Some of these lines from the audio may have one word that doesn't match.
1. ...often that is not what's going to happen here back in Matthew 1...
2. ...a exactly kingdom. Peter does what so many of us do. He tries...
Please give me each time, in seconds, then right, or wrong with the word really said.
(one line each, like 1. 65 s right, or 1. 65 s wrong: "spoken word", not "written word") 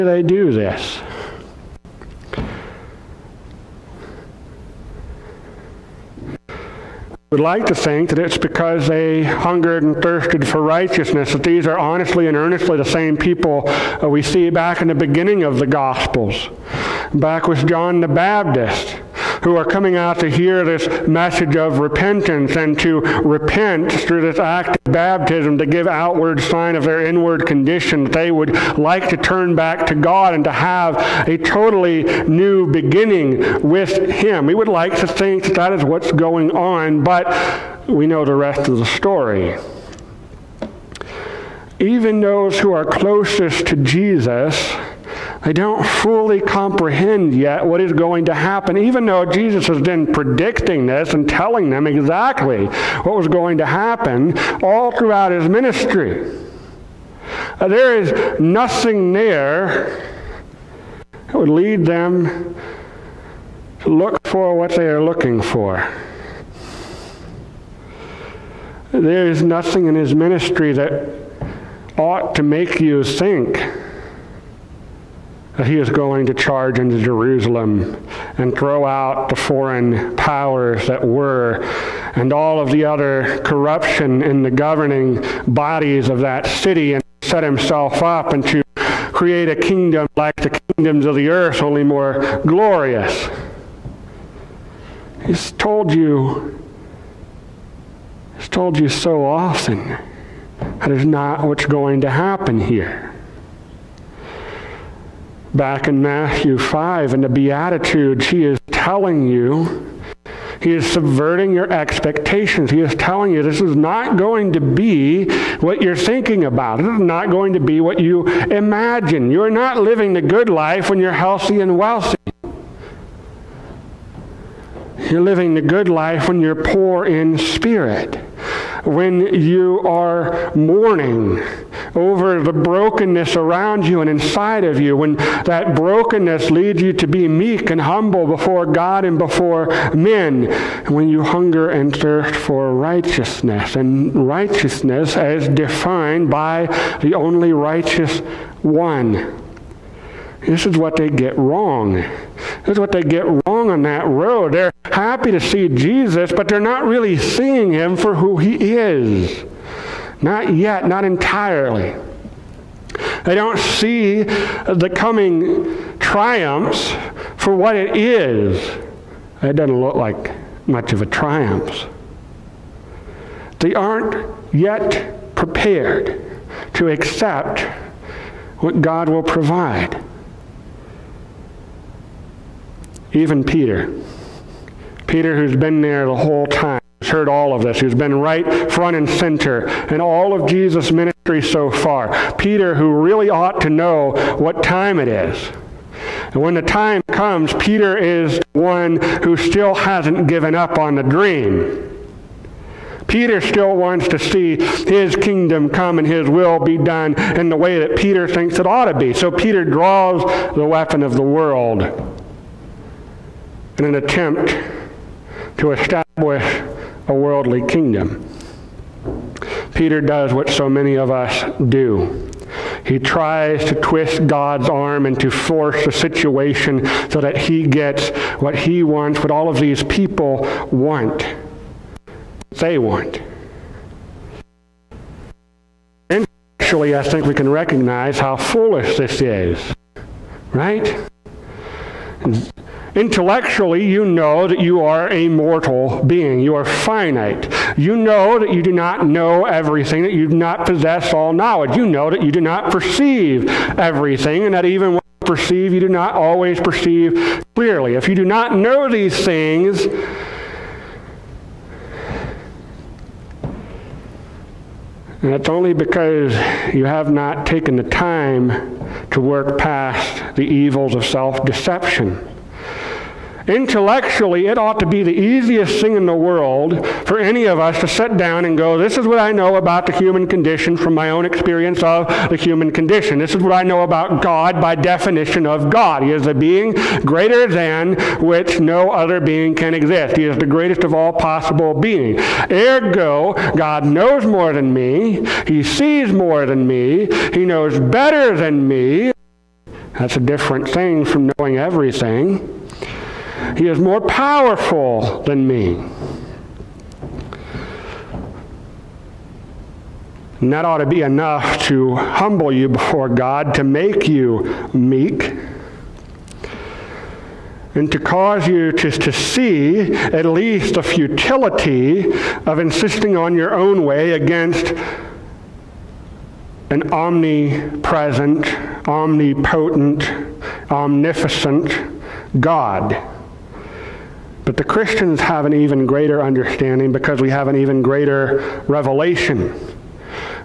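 1. 99 s wrong: "5", not "1"
2. 217 s wrong: "worldly", not "exactly".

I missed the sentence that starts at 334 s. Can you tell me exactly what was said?
But the Christians have an even greater understanding because we have an even greater revelation.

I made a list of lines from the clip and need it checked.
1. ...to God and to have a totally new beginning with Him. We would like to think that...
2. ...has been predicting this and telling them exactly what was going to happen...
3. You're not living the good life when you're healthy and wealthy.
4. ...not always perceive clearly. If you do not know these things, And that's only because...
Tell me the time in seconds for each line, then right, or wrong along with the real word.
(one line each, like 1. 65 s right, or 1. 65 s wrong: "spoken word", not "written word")
1. 29 s right
2. 49 s right
3. 119 s right
4. 255 s right.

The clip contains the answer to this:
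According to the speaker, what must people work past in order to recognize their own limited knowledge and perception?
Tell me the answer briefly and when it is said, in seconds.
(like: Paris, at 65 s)
self deception, at 271 s.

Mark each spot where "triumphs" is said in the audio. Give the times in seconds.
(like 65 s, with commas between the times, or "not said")
165 s, 171 s.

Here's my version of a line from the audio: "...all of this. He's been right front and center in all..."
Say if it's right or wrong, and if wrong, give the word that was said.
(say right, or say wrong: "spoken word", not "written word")
right.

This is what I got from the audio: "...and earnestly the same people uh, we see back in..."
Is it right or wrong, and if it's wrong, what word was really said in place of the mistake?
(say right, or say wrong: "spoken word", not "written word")
right.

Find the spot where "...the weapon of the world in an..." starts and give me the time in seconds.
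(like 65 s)
210 s.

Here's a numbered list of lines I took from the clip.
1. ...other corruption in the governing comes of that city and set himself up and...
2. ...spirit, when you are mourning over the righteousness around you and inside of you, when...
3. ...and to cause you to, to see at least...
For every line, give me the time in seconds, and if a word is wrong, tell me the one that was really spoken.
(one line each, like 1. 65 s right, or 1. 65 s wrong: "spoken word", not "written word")
1. 82 s wrong: "bodies", not "comes"
2. 127 s wrong: "brokenness", not "righteousness"
3. 317 s right.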